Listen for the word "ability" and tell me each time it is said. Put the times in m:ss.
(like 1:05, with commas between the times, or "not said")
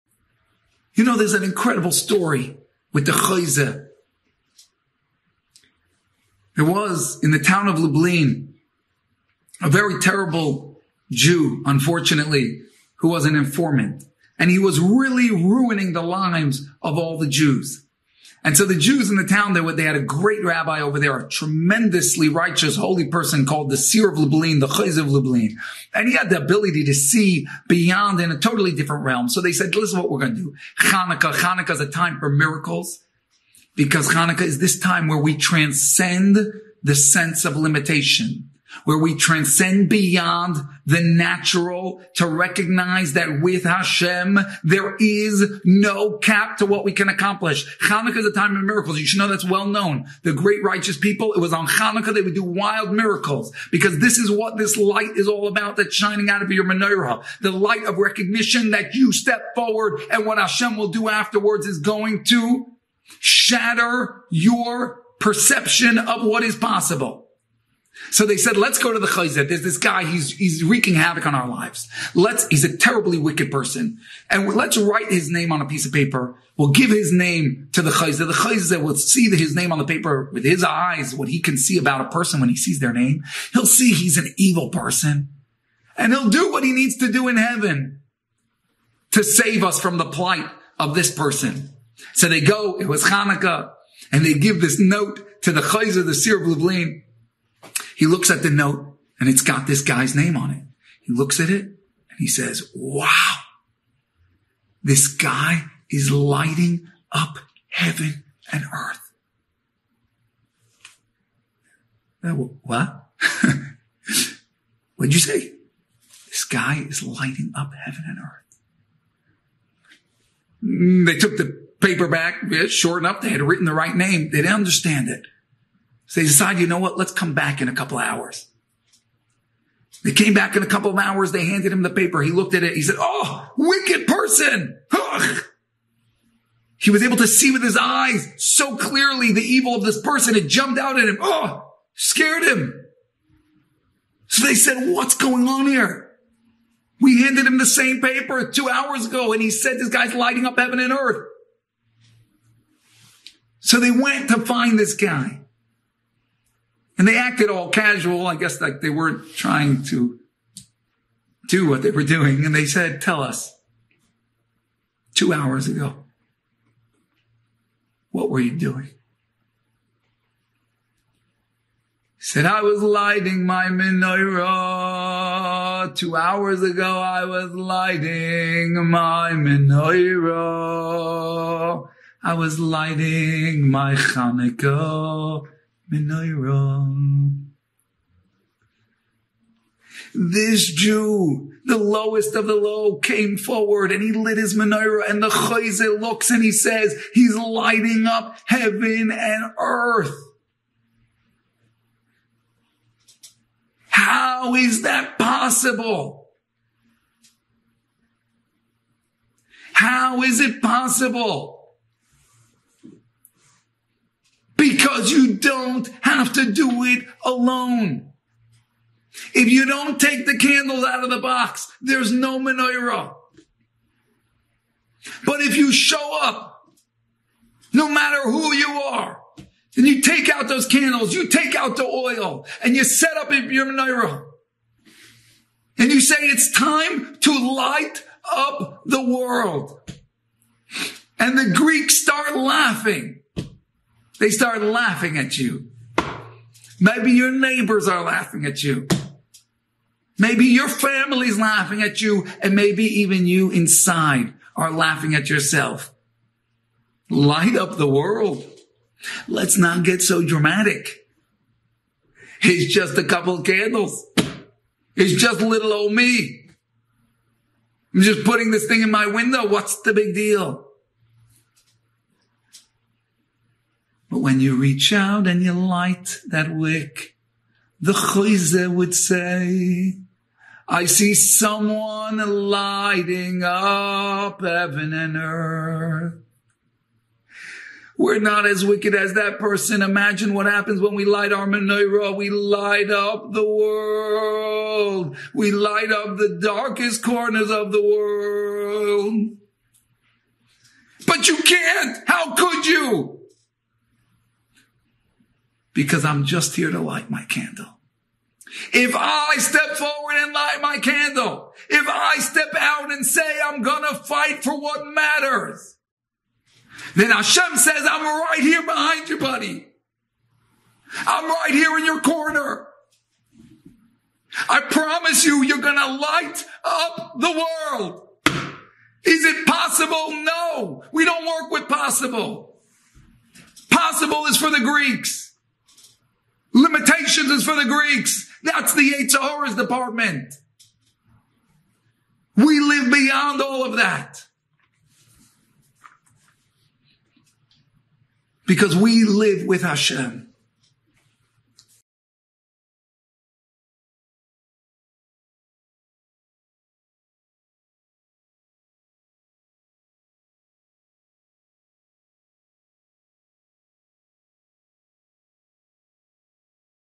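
0:26.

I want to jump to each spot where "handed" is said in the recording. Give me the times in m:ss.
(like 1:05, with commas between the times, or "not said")
2:11, 2:27.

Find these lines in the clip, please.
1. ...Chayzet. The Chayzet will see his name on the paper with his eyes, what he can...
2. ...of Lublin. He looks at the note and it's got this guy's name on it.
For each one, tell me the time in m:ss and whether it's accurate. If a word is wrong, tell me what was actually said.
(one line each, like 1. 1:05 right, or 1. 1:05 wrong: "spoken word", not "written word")
1. 1:17 right
2. 1:36 right.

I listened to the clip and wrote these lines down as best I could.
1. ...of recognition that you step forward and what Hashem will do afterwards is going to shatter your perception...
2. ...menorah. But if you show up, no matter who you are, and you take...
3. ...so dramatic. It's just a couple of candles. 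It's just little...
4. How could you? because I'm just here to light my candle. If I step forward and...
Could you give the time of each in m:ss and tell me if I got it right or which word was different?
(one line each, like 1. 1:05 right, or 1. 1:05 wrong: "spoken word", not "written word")
1. 0:57 right
2. 3:42 right
3. 4:20 right
4. 5:02 right.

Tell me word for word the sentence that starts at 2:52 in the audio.
He said, I was lighting my menorah.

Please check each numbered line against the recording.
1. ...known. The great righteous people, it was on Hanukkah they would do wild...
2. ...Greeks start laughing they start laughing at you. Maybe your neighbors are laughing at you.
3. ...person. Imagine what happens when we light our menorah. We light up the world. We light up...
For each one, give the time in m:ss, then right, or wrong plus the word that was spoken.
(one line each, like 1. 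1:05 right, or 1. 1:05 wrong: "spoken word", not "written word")
1. 0:49 right
2. 4:01 right
3. 4:49 right.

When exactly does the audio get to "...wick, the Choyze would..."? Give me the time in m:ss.
4:36.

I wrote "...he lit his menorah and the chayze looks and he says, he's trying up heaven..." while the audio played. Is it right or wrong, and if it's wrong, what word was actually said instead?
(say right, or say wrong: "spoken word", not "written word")
wrong: "lighting", not "trying".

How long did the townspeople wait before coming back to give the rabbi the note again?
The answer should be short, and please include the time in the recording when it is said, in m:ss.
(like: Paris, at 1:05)
a couple hours, at 2:07.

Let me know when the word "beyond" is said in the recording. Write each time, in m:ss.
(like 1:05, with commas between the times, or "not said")
0:27, 0:39, 5:42.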